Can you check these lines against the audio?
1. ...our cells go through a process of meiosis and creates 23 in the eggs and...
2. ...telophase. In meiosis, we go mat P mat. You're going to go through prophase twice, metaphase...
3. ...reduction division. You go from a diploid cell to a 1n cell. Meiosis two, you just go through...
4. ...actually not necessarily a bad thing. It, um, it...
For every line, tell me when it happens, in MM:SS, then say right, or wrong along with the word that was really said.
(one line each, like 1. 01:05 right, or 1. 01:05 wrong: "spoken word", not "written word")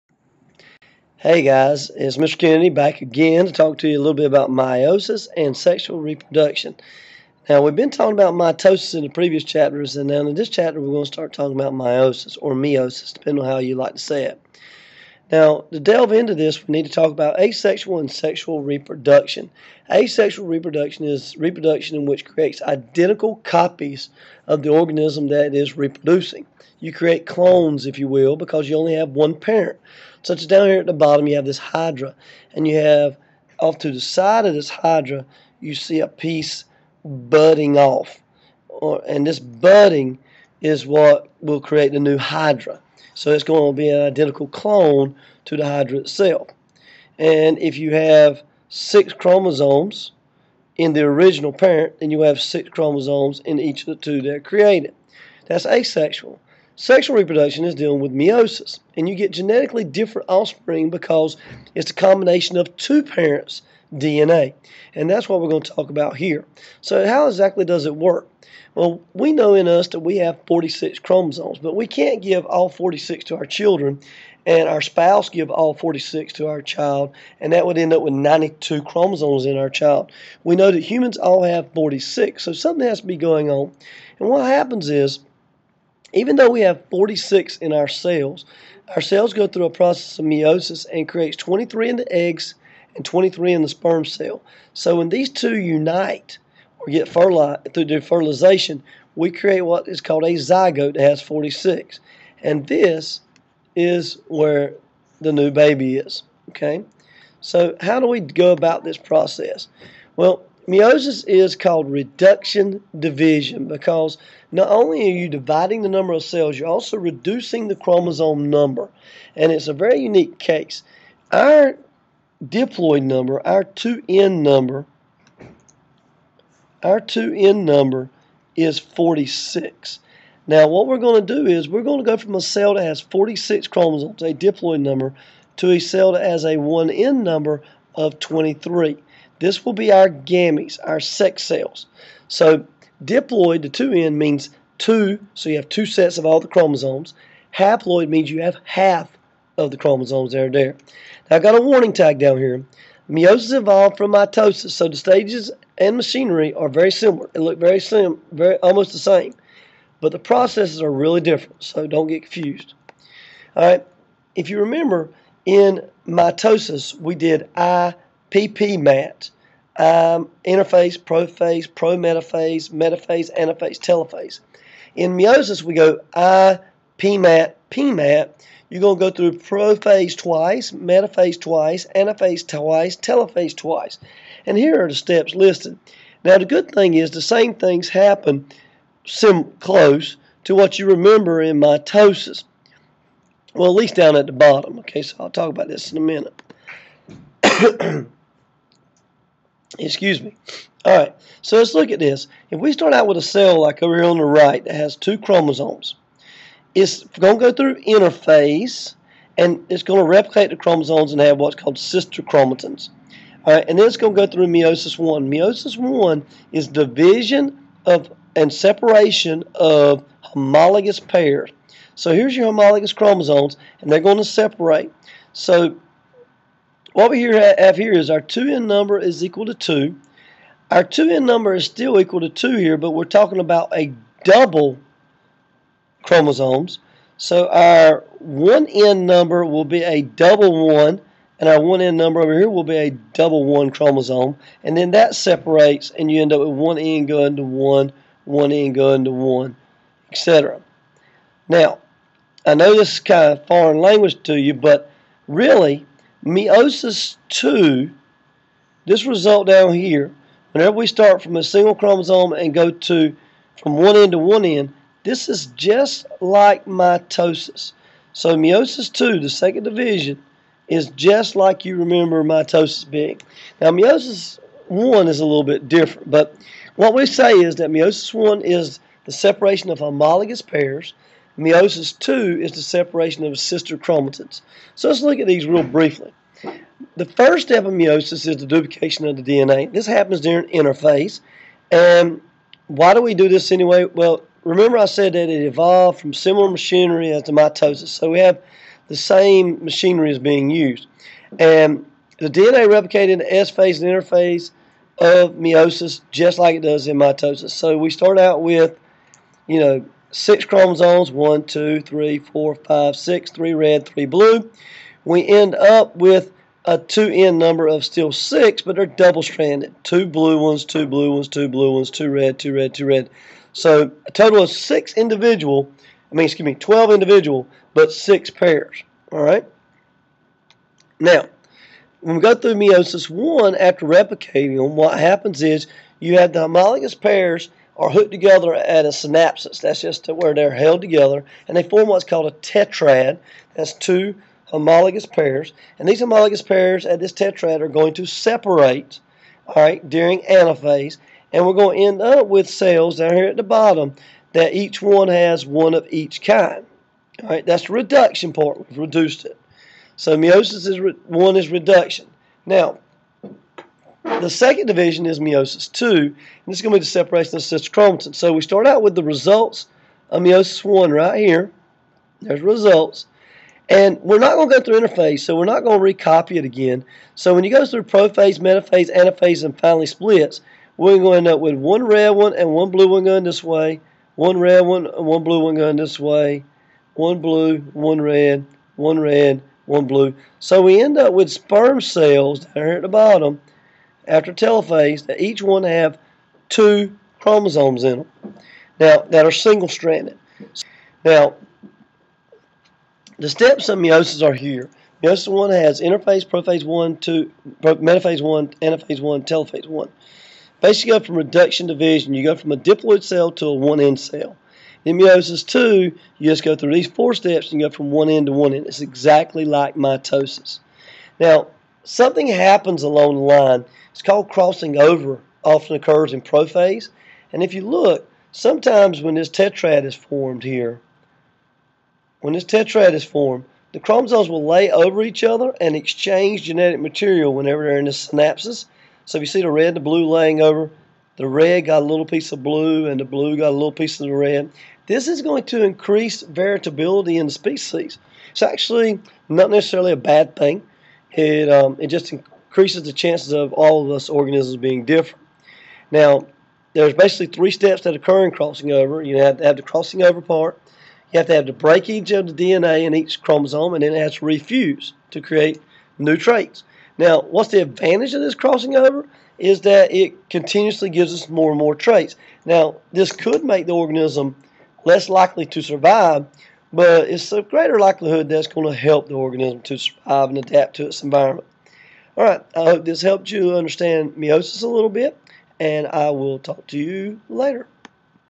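1. 01:28 right
2. 02:53 right
3. 06:51 right
4. 07:28 right.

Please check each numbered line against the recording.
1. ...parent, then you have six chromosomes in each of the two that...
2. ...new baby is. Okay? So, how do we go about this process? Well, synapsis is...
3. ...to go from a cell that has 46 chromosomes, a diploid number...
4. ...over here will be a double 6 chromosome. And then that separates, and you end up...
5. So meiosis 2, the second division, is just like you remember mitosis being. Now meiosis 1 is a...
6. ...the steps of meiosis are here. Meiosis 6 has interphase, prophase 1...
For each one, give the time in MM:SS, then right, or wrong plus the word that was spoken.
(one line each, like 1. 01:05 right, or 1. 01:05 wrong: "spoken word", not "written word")
1. 00:51 right
2. 01:45 wrong: "meiosis", not "synapsis"
3. 02:11 right
4. 04:02 wrong: "1", not "6"
5. 04:28 right
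6. 06:43 wrong: "1", not "6".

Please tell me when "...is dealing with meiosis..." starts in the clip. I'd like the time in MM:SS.
00:57.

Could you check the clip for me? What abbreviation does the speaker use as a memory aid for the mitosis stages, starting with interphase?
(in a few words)
IPP mat.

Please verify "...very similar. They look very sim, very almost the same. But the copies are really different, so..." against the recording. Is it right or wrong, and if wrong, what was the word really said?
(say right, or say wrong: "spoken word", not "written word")
wrong: "processes", not "copies".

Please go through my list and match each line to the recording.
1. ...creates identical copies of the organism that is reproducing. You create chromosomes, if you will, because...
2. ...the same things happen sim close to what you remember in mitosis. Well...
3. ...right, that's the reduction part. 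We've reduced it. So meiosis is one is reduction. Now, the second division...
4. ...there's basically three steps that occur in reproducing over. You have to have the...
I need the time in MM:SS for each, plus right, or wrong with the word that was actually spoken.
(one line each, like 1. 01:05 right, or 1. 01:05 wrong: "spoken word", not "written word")
1. 00:22 wrong: "clones", not "chromosomes"
2. 03:07 right
3. 05:57 right
4. 07:36 wrong: "crossing", not "reproducing".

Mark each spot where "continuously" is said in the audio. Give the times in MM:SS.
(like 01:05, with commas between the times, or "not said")
07:50.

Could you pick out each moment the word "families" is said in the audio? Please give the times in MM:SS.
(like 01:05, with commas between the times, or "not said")
not said.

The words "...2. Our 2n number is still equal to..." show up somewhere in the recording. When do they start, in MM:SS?
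03:49.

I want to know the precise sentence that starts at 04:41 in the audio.
Meiosis two is the separation of sister chromatids.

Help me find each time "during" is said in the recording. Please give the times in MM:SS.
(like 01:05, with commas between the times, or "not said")
04:50, 05:49.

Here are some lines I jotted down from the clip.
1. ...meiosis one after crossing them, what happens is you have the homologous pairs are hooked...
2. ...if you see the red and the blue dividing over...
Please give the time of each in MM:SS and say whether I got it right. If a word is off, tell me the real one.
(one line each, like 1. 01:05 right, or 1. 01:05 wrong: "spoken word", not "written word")
1. 05:32 wrong: "replicating", not "crossing"
2. 07:19 wrong: "laying", not "dividing".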